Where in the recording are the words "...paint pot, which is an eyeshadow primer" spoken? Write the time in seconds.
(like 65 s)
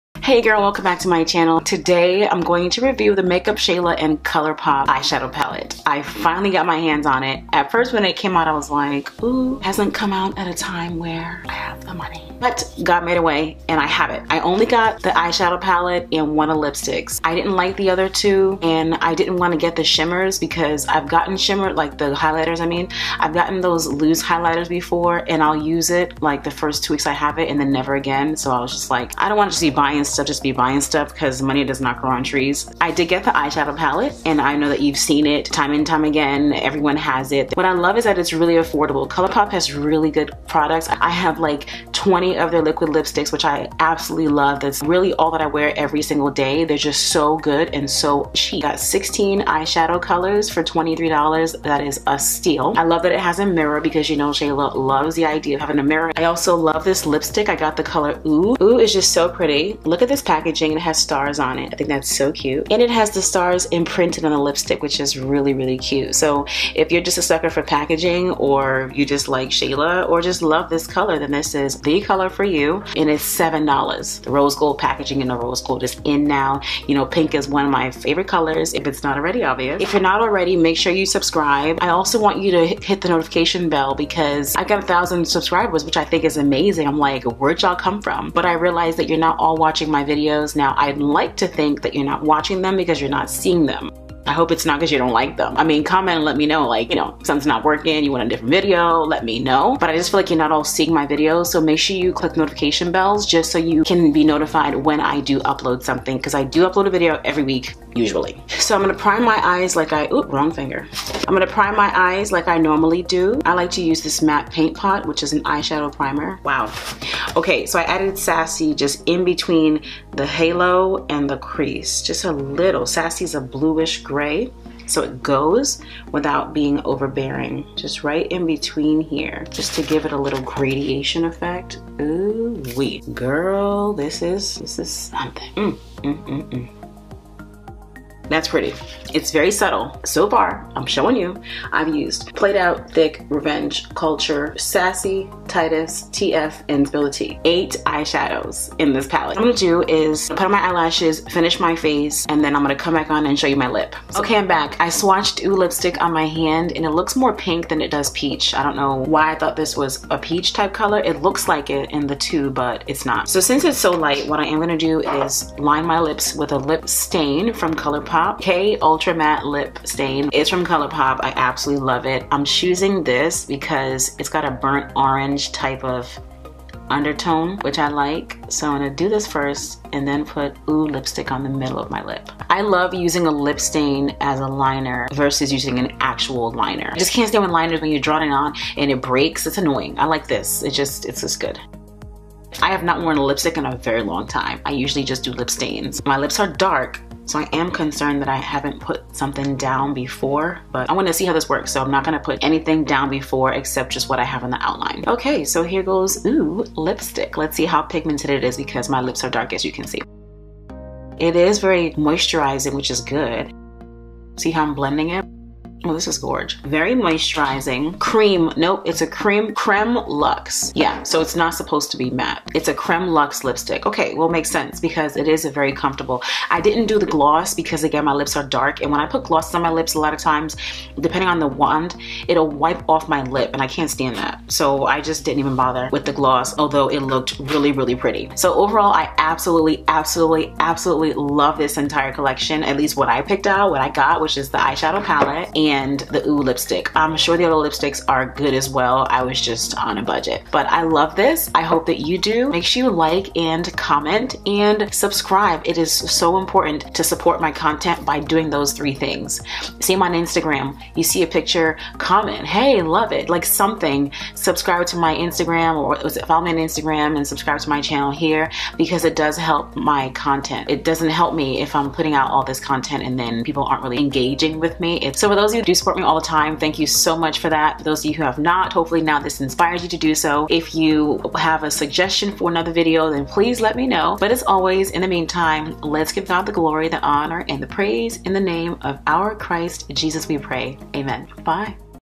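114 s.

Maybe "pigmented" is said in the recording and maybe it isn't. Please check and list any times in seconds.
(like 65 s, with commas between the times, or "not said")
207 s.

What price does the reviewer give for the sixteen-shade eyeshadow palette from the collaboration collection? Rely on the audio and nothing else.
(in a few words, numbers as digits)
$23.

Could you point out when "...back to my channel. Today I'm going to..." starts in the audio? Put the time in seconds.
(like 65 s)
0 s.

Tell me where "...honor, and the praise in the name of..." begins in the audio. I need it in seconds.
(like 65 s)
287 s.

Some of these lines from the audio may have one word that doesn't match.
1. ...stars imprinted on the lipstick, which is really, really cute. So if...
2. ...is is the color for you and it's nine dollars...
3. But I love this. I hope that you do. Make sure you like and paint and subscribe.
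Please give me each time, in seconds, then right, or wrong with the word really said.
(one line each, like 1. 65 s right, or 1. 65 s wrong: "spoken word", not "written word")
1. 63 s right
2. 71 s wrong: "seven", not "nine"
3. 250 s wrong: "comment", not "paint".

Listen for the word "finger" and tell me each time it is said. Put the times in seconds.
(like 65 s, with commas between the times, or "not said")
110 s.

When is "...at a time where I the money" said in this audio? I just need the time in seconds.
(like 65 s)
10 s.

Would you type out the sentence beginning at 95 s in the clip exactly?
I mean, comment and let me know, like, you know, something's not working, you want a different video, let me know.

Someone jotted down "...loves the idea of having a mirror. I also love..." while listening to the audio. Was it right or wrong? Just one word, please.
right.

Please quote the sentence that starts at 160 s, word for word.
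It looks like it in the tube, but it's not.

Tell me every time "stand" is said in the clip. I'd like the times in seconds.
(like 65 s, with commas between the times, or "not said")
187 s, 233 s.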